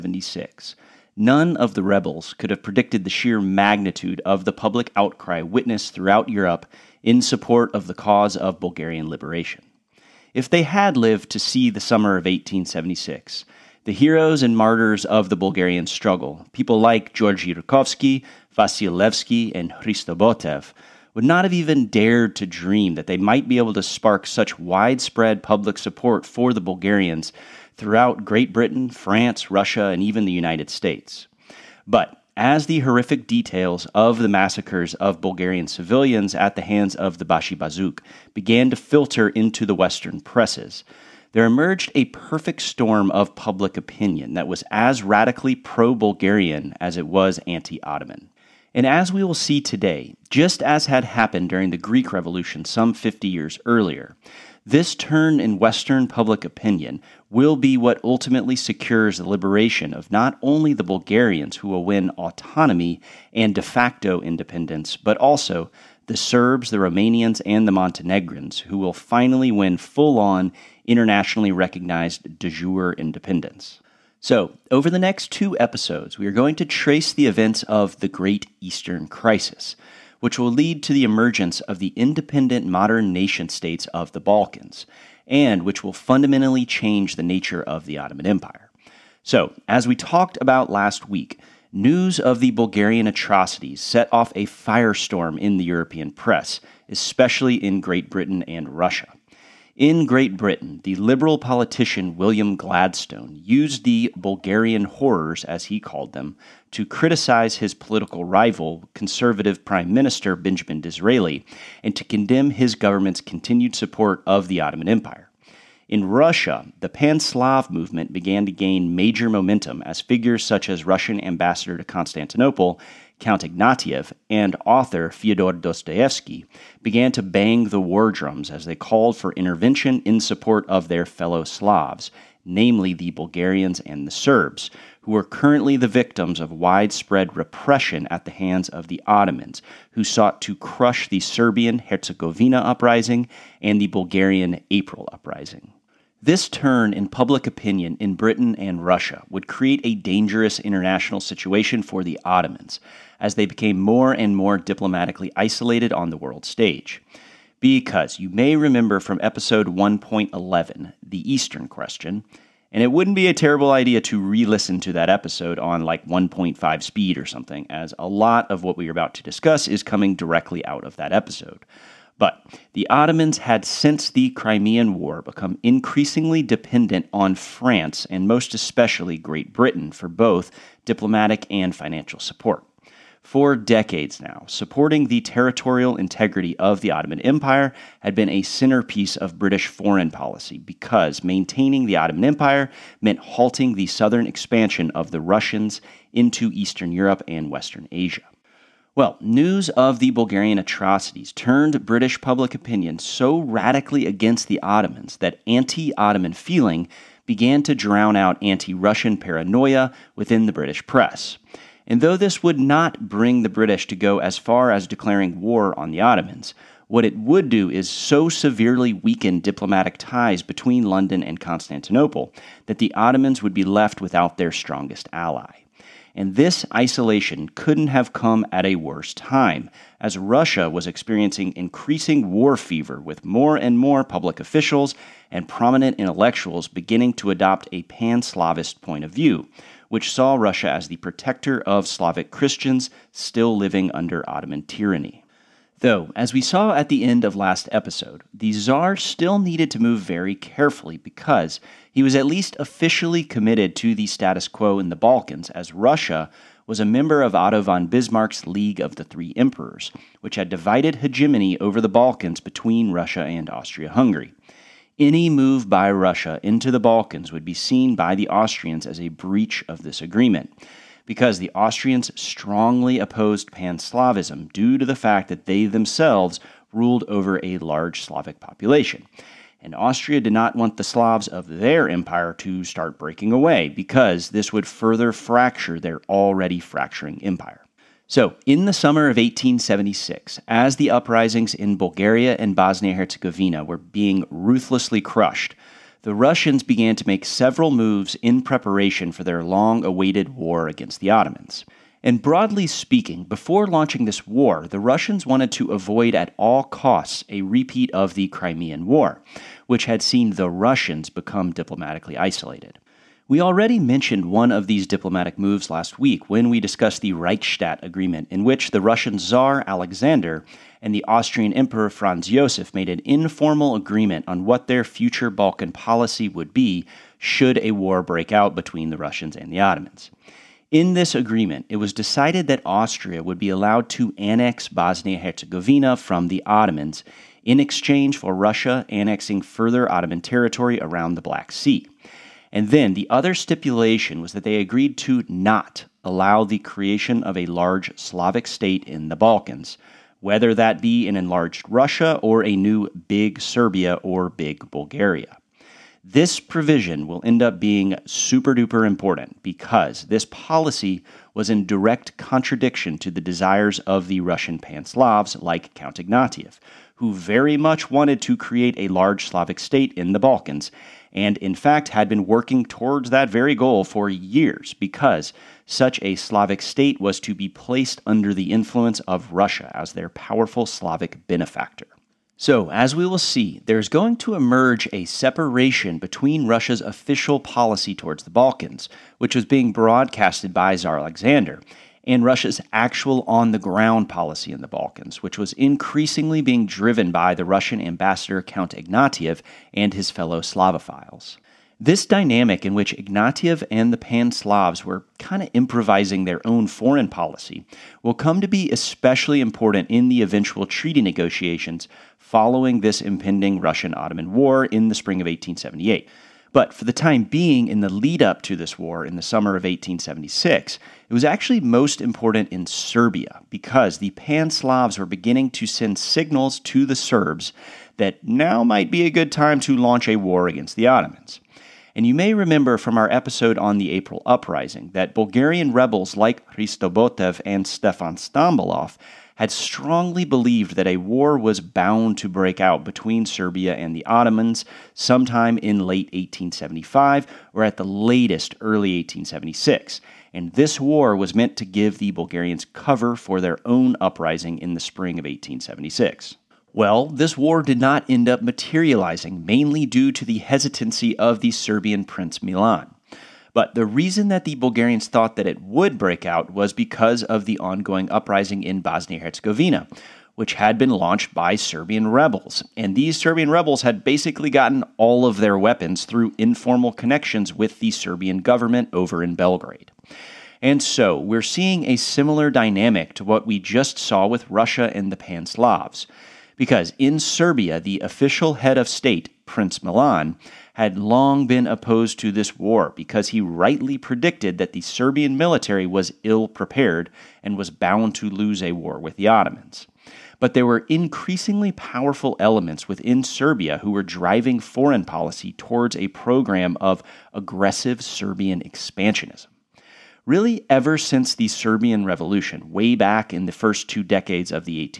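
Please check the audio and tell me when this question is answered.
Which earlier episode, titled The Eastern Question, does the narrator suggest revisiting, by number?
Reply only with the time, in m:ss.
2:39.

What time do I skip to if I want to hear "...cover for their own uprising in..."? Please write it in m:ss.
7:32.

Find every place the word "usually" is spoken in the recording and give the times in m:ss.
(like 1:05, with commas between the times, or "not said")
not said.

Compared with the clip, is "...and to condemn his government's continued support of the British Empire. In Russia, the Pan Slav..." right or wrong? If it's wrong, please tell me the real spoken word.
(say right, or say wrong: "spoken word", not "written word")
wrong: "Ottoman", not "British".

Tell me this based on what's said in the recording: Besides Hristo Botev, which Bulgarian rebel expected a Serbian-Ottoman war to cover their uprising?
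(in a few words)
Stefan Stambolov.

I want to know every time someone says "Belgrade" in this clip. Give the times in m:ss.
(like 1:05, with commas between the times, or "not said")
7:59.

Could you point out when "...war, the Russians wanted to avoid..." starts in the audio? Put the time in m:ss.
5:04.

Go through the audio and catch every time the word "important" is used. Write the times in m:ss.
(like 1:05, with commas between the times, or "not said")
5:58, 6:49, 7:02.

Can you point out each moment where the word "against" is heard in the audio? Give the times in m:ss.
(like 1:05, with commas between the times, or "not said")
3:24, 5:00, 7:10.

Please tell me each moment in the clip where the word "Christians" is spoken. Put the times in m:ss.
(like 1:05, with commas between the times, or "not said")
4:02.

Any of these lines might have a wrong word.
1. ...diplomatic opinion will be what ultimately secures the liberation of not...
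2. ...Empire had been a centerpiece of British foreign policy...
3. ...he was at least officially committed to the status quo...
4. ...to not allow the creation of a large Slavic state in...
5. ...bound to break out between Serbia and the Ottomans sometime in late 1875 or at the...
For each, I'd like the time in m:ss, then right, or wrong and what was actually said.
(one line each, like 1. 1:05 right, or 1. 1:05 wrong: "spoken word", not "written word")
1. 0:56 wrong: "public", not "diplomatic"
2. 3:07 right
3. 4:11 right
4. 5:44 right
5. 7:21 right.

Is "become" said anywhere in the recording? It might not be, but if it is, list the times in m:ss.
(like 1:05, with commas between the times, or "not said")
2:55, 5:11.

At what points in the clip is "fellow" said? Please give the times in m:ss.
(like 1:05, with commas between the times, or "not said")
2:11, 6:40.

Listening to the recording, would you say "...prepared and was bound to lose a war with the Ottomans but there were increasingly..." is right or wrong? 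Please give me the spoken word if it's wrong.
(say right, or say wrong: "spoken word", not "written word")
right.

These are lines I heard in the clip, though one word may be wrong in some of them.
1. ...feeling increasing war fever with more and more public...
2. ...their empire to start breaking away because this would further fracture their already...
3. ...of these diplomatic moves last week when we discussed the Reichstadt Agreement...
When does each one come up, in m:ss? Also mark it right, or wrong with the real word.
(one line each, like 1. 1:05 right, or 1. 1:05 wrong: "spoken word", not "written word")
1. 3:50 wrong: "experiencing", not "feeling"
2. 4:41 right
3. 5:14 right.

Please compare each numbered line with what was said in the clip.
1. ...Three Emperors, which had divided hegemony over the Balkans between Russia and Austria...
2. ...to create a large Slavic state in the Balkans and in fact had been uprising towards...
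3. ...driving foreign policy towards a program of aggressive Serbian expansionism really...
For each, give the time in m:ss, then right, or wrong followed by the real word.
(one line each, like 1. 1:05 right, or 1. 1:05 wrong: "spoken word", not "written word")
1. 4:19 right
2. 6:08 wrong: "working", not "uprising"
3. 8:24 right.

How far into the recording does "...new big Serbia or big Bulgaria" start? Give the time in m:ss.
5:52.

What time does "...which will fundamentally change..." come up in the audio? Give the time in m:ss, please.
1:25.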